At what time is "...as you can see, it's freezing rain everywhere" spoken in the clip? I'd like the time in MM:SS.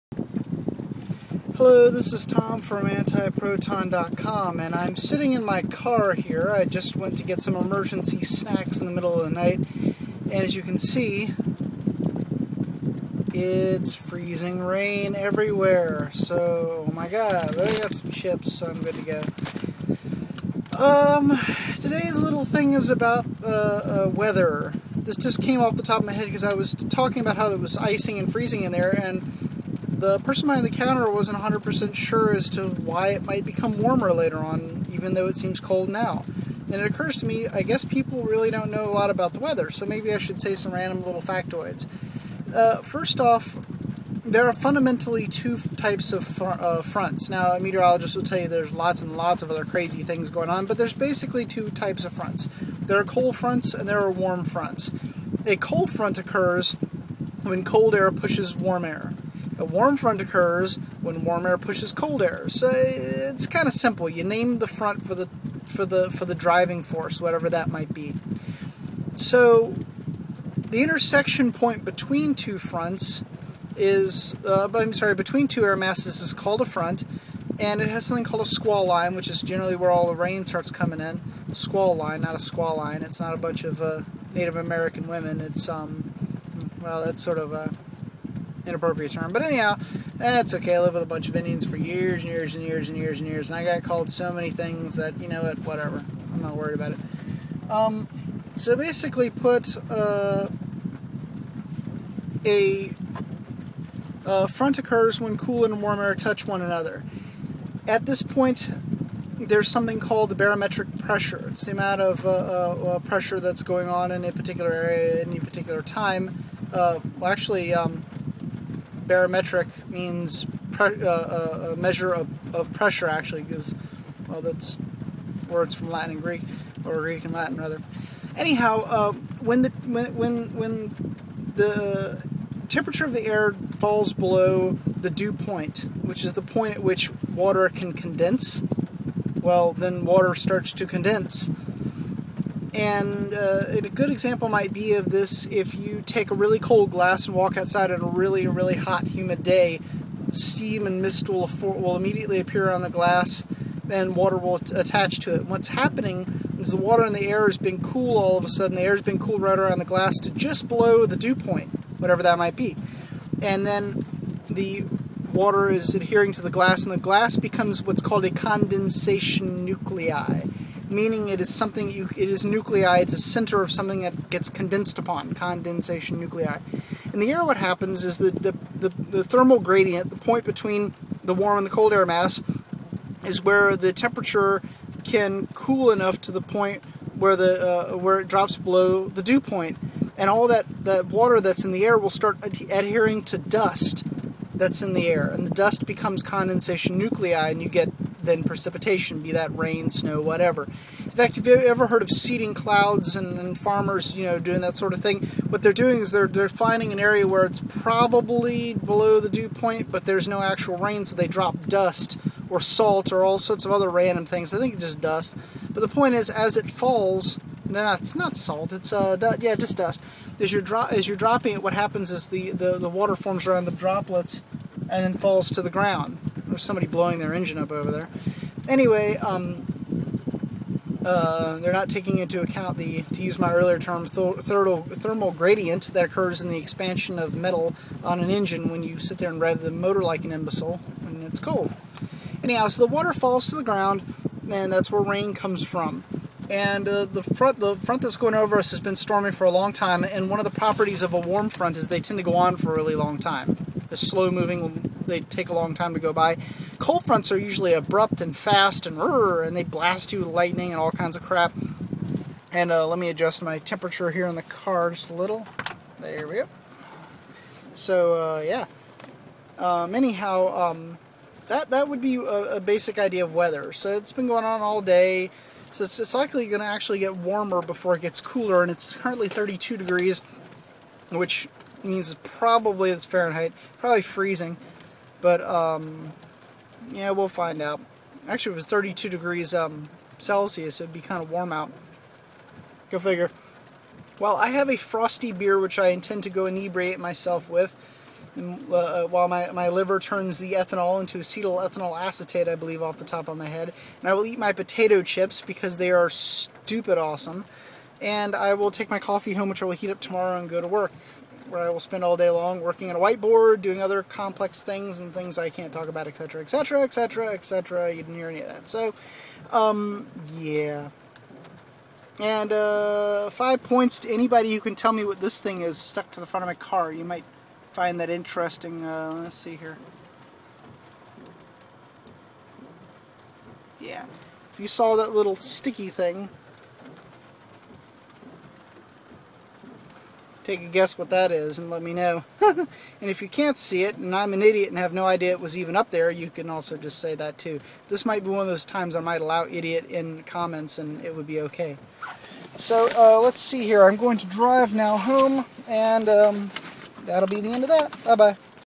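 00:10.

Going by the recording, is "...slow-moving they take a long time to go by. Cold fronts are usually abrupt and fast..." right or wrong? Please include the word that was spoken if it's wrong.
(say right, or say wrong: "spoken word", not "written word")
right.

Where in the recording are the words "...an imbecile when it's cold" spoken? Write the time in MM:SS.
04:00.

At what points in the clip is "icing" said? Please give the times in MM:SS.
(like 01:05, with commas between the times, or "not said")
00:27.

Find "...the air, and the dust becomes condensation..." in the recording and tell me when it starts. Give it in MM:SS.
03:14.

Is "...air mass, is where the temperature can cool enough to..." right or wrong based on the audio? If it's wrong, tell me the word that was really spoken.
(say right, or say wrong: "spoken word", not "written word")
right.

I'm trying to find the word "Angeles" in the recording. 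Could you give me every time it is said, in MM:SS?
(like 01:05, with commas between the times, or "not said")
not said.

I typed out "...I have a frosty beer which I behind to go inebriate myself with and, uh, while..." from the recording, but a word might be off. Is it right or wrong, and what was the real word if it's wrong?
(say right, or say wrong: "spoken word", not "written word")
wrong: "intend", not "behind".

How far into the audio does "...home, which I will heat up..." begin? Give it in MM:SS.
05:09.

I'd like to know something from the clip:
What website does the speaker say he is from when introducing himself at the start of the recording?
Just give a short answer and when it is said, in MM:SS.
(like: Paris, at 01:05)
antiproton.com, at 00:02.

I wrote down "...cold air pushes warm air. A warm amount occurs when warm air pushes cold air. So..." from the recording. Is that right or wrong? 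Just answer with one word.
wrong.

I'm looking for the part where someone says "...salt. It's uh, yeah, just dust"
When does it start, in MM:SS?
03:38.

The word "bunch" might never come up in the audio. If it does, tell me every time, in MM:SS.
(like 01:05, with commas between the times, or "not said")
01:23, 01:31.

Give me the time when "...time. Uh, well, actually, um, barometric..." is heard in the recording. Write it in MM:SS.
01:55.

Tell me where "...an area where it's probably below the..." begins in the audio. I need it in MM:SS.
03:26.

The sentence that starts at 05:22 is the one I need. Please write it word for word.
And uh, five points to anybody who can tell me what this thing is stuck to the front of my car.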